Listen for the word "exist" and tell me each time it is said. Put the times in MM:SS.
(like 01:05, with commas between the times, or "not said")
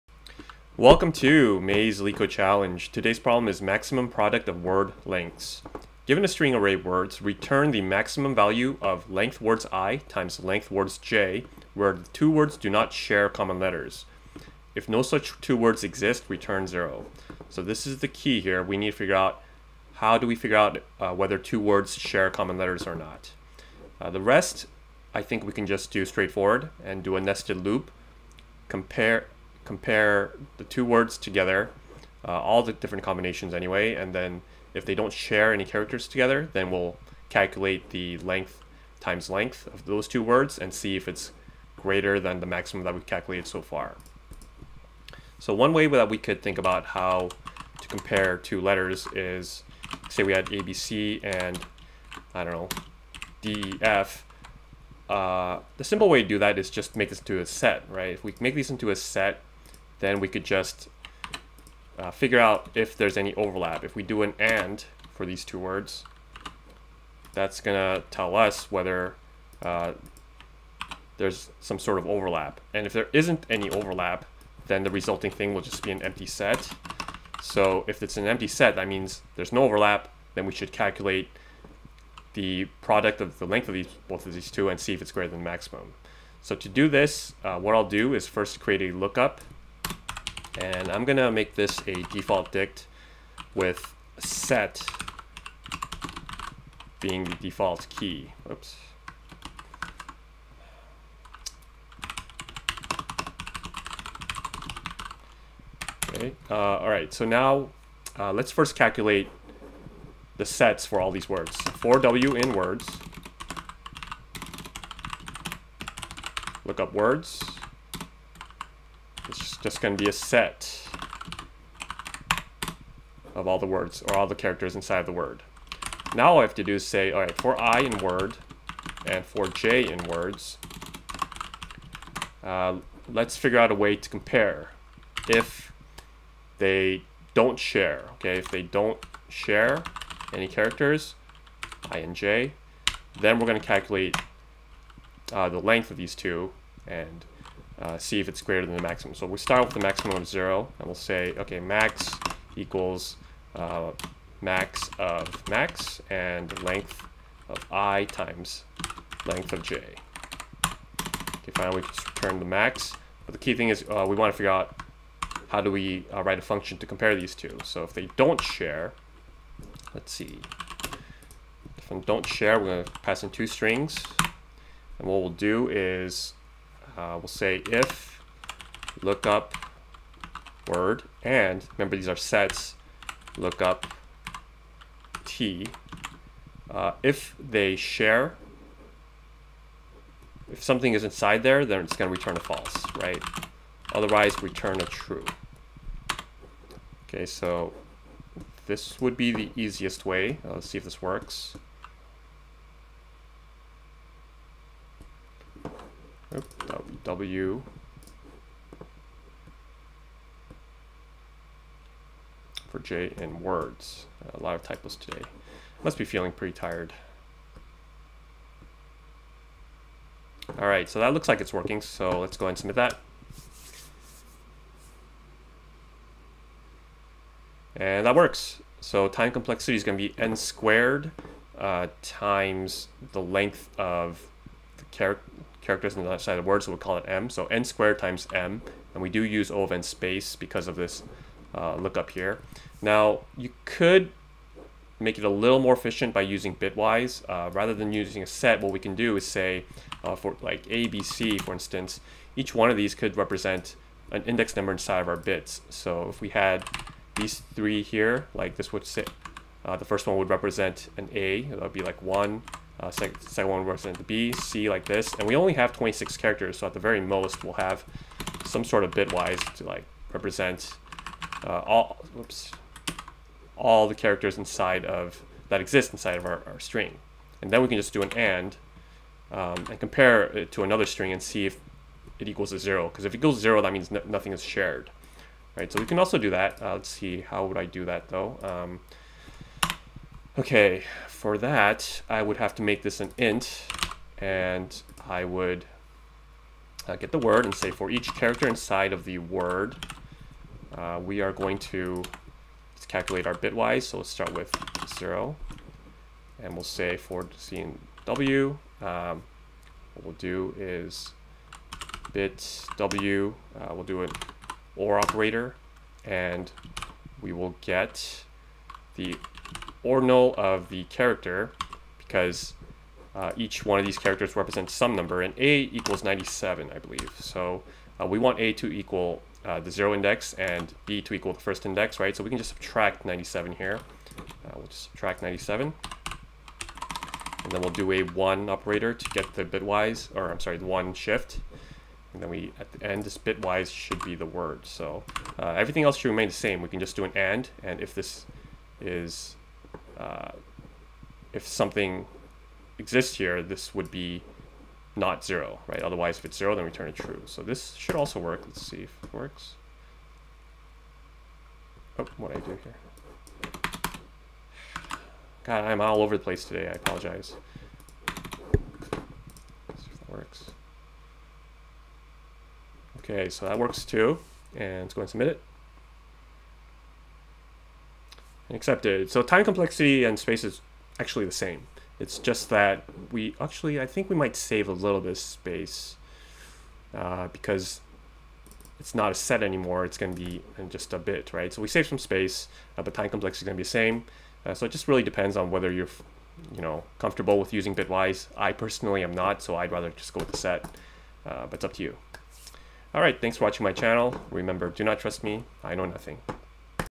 00:15, 04:35, 05:52.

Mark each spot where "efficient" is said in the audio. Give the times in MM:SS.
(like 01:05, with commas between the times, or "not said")
04:05.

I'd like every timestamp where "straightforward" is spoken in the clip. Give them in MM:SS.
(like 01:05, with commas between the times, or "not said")
00:26.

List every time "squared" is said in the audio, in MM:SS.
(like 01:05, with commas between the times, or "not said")
03:50, 03:57.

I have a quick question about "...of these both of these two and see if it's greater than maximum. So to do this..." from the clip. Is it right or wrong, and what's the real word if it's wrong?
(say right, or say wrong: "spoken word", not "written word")
right.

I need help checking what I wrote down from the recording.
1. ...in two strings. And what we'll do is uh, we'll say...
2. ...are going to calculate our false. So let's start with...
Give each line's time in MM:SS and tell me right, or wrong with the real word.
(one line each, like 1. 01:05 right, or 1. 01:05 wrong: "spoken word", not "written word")
1. 02:53 right
2. 05:01 wrong: "bitwise", not "false".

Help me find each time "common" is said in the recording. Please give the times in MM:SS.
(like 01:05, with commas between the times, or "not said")
00:13, 00:22.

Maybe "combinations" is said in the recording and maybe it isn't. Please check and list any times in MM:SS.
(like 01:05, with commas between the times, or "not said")
00:33.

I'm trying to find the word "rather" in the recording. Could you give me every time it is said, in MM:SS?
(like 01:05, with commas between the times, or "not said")
04:07, 06:39.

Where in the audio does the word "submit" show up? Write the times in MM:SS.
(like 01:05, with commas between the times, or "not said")
03:42, 06:15.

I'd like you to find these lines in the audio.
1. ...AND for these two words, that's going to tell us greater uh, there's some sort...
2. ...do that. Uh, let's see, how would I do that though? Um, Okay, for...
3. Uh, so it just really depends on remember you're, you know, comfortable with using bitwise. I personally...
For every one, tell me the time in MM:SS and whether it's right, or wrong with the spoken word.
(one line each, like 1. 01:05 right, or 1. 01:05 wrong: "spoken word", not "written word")
1. 01:04 wrong: "whether", not "greater"
2. 04:46 right
3. 06:34 wrong: "whether", not "remember".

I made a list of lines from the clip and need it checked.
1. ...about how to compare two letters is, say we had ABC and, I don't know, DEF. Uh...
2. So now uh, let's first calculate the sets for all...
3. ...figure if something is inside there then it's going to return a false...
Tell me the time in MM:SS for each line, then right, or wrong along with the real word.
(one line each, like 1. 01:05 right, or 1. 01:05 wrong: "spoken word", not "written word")
1. 00:46 right
2. 01:47 right
3. 03:07 wrong: "share", not "figure".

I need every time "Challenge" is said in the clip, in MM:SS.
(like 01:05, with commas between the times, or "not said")
00:02.